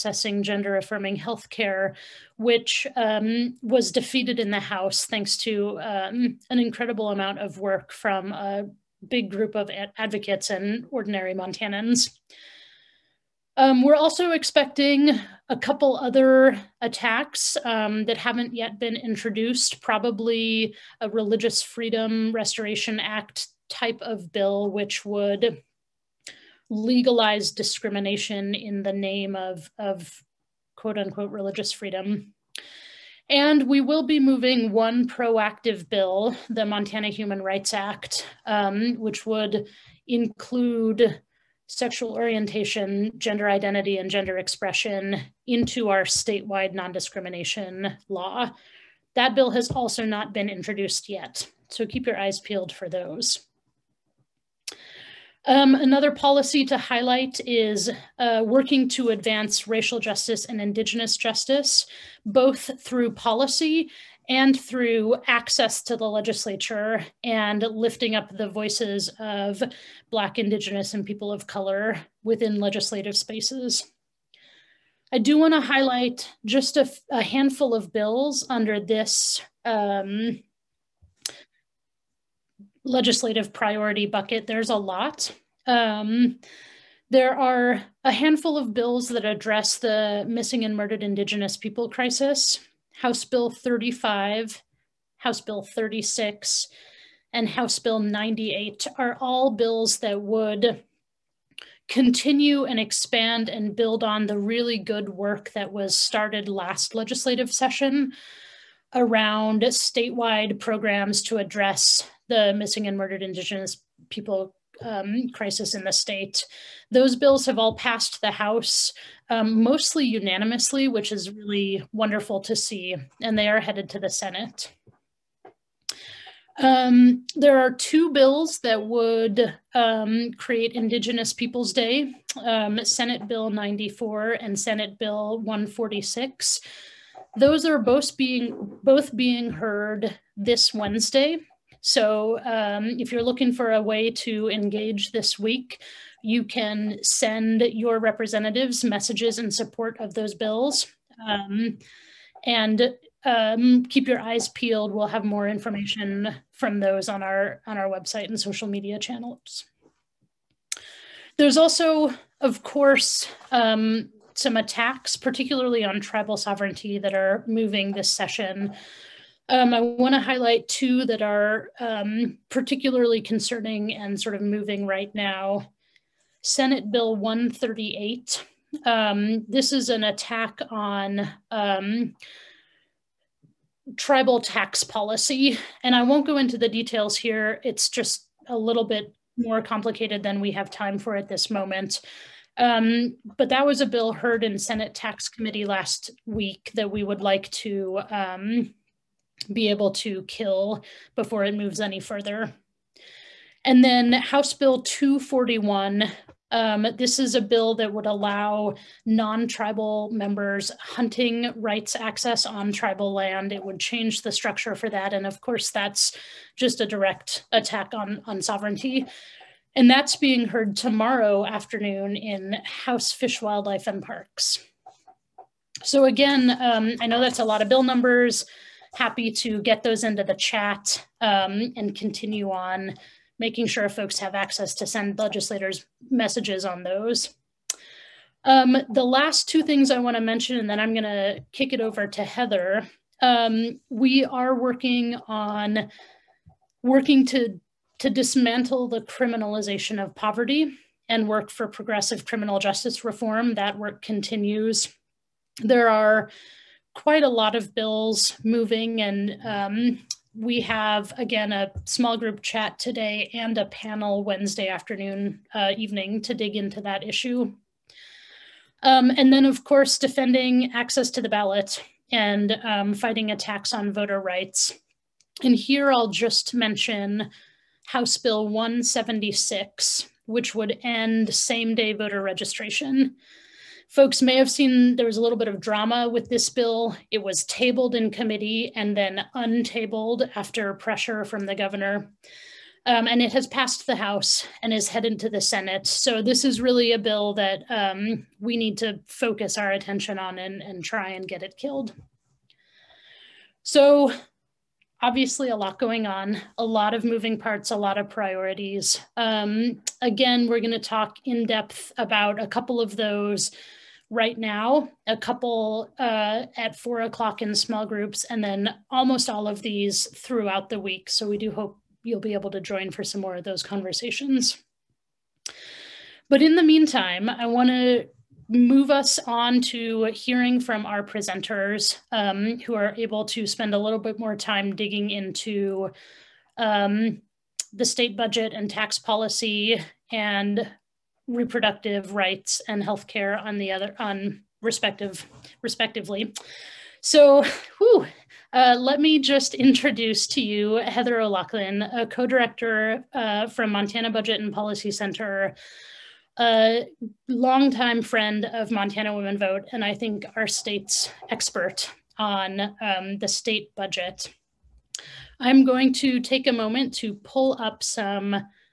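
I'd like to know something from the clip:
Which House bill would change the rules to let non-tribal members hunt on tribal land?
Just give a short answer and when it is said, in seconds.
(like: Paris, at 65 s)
House Bill 241, at 204 s.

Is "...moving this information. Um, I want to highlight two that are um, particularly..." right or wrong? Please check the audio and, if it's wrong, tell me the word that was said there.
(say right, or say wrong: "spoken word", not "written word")
wrong: "session", not "information".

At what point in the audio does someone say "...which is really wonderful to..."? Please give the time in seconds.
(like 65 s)
120 s.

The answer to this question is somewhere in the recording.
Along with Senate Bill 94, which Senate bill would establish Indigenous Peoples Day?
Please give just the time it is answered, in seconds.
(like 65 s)
134 s.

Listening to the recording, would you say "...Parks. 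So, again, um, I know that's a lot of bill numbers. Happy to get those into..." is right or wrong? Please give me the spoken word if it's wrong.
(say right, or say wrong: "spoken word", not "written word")
right.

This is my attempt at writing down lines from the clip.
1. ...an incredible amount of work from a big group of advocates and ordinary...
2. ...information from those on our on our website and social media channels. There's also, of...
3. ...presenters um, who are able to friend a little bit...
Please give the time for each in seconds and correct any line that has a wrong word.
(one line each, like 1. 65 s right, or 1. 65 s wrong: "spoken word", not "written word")
1. 6 s right
2. 155 s right
3. 331 s wrong: "spend", not "friend".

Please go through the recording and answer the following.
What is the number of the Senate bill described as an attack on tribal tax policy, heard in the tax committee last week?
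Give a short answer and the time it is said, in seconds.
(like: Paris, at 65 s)
Senate Bill 138, at 176 s.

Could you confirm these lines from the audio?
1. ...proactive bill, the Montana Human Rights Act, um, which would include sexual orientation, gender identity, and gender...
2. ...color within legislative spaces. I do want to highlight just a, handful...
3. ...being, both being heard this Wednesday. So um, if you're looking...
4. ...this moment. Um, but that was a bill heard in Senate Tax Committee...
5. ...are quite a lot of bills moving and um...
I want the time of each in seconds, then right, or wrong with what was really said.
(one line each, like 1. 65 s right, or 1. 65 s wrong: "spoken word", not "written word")
1. 35 s right
2. 71 s right
3. 138 s right
4. 191 s right
5. 255 s right.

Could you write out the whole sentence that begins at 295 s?
So this is really a bill that um, we need to focus our attention on and, and try and get it killed.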